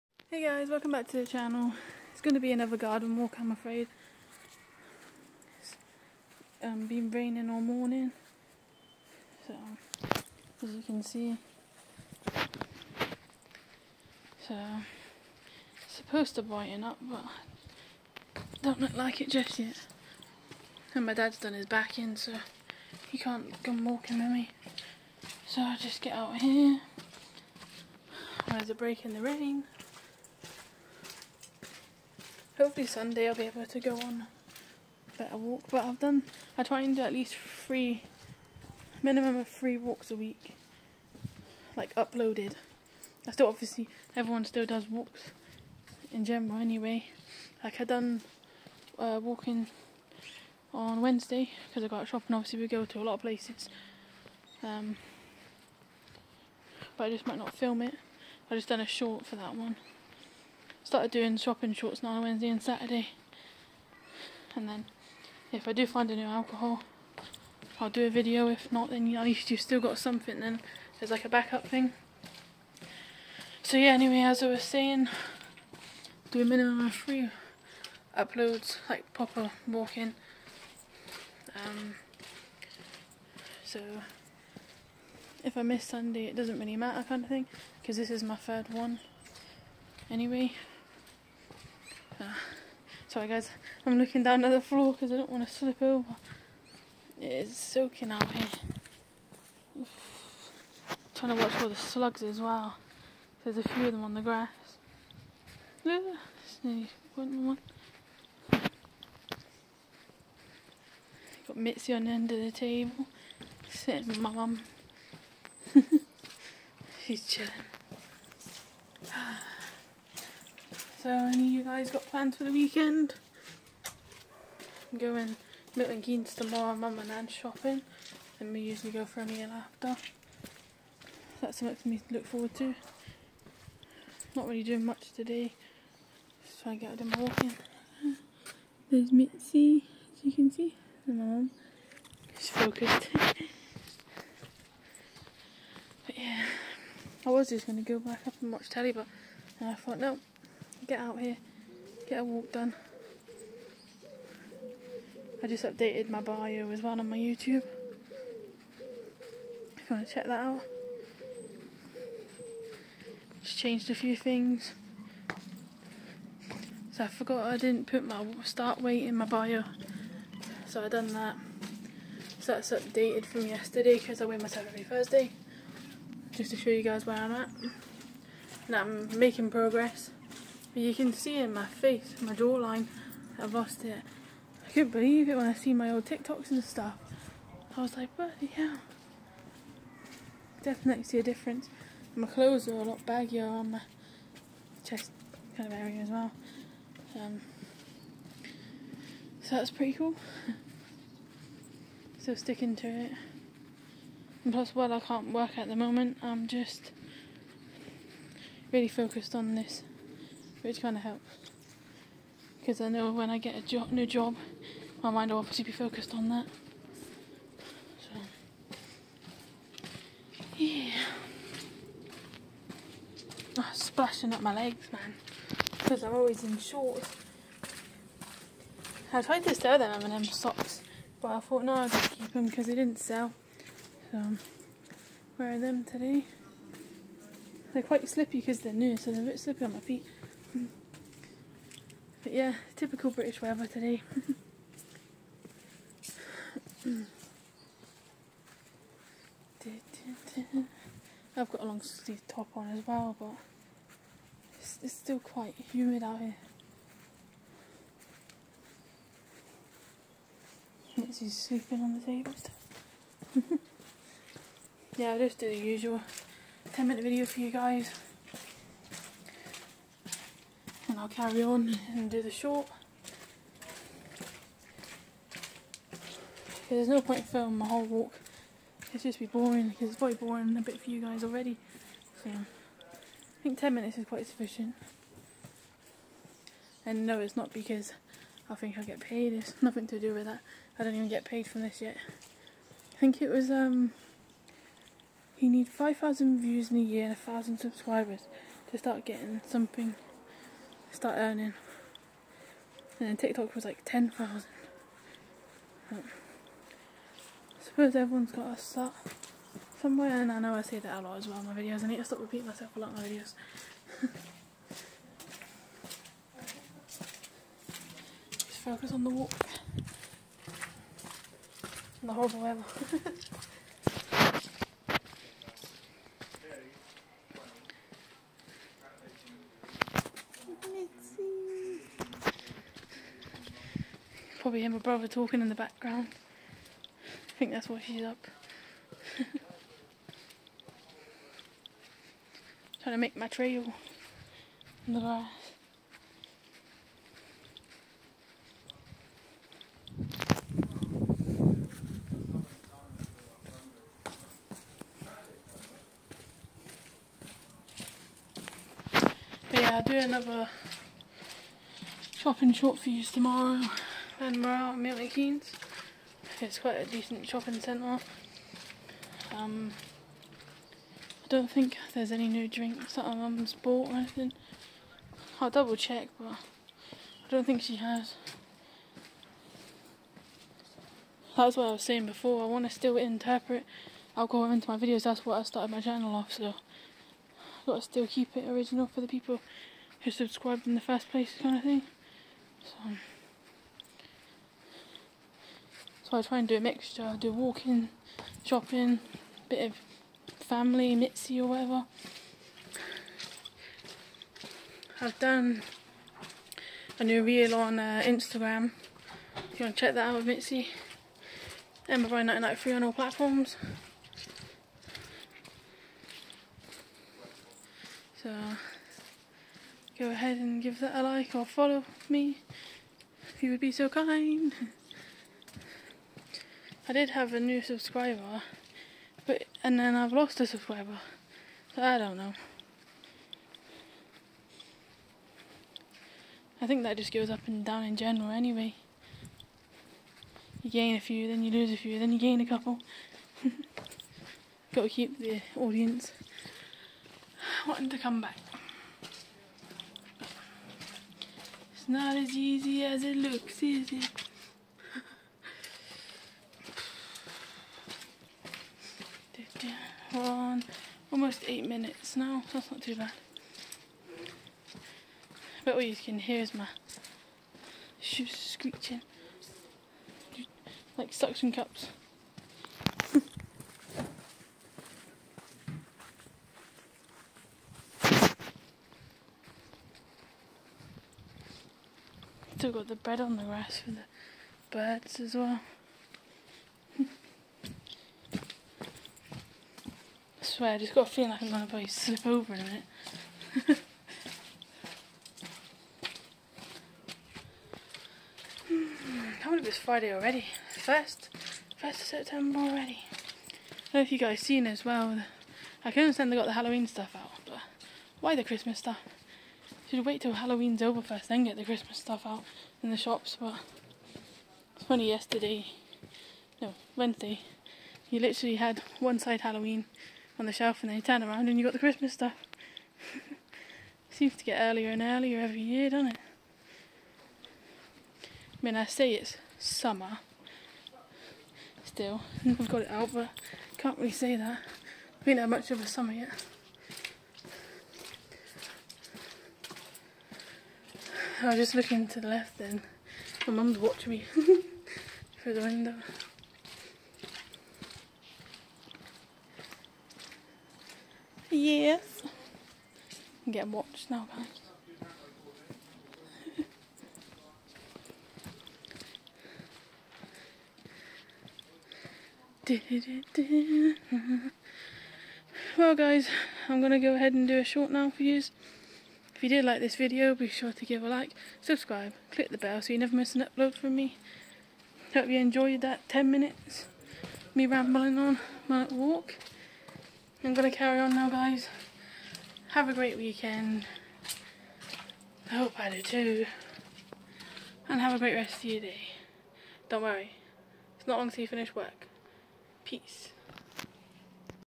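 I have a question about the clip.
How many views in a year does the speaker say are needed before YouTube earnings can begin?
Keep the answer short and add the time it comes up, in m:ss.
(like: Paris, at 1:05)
5,000, at 4:55.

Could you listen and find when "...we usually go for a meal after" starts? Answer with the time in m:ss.
2:08.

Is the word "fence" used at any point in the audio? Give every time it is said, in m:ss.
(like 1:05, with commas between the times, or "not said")
not said.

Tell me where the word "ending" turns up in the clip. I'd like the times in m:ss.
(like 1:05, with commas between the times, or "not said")
not said.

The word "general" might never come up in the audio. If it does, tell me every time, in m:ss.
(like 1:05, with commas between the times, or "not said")
0:46, 7:17.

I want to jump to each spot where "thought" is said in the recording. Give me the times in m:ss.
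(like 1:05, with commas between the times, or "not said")
2:29, 3:51.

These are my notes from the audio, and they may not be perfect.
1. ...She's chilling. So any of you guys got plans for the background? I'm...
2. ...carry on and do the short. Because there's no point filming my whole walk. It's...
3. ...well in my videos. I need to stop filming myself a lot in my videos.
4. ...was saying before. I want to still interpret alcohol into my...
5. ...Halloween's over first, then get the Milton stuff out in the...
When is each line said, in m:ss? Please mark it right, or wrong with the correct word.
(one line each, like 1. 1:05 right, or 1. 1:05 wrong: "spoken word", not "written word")
1. 1:57 wrong: "weekend", not "background"
2. 4:31 right
3. 5:11 wrong: "repeating", not "filming"
4. 6:21 right
5. 8:30 wrong: "Christmas", not "Milton".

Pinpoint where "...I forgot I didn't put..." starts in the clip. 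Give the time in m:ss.
2:47.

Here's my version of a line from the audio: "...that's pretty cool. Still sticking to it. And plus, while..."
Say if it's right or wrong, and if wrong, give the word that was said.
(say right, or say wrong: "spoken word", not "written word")
right.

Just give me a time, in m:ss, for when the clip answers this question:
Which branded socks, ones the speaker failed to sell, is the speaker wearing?
3:50.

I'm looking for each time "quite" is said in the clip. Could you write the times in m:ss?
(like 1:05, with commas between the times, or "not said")
3:57, 4:15, 4:44, 6:06.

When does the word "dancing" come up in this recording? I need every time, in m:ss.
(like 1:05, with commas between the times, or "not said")
not said.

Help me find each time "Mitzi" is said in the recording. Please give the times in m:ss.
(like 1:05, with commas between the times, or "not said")
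1:51, 2:19, 4:20, 6:40, 6:50.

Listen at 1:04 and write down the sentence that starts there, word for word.
And then if I do find a new alcohol, I'll do a video.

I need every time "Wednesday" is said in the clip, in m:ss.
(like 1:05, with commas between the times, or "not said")
0:51, 1:02, 8:36.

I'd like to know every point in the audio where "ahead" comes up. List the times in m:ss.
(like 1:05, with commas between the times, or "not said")
7:00, 9:27.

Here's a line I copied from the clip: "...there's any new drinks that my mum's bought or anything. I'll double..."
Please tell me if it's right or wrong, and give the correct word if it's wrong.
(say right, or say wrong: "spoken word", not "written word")
right.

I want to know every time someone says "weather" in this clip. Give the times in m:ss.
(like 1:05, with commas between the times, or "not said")
4:03, 5:22.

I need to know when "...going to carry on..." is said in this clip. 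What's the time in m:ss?
9:40.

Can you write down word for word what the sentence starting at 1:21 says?
Um, so if I miss Sunday, it doesn't really matter kind of thing, because this is my third one anyway.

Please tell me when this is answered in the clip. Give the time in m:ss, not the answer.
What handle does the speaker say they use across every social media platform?
6:51.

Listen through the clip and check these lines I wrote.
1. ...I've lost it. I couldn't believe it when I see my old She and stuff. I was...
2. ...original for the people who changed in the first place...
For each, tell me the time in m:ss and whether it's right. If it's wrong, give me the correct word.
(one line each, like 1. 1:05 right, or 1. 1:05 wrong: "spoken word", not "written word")
1. 3:03 wrong: "TikToks", not "She"
2. 6:28 wrong: "subscribed", not "changed".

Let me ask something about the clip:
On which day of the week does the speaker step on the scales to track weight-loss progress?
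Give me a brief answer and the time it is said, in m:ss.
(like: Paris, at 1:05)
Thursday, at 2:54.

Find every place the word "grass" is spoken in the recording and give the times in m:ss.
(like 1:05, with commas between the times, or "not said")
1:44, 5:44, 8:03.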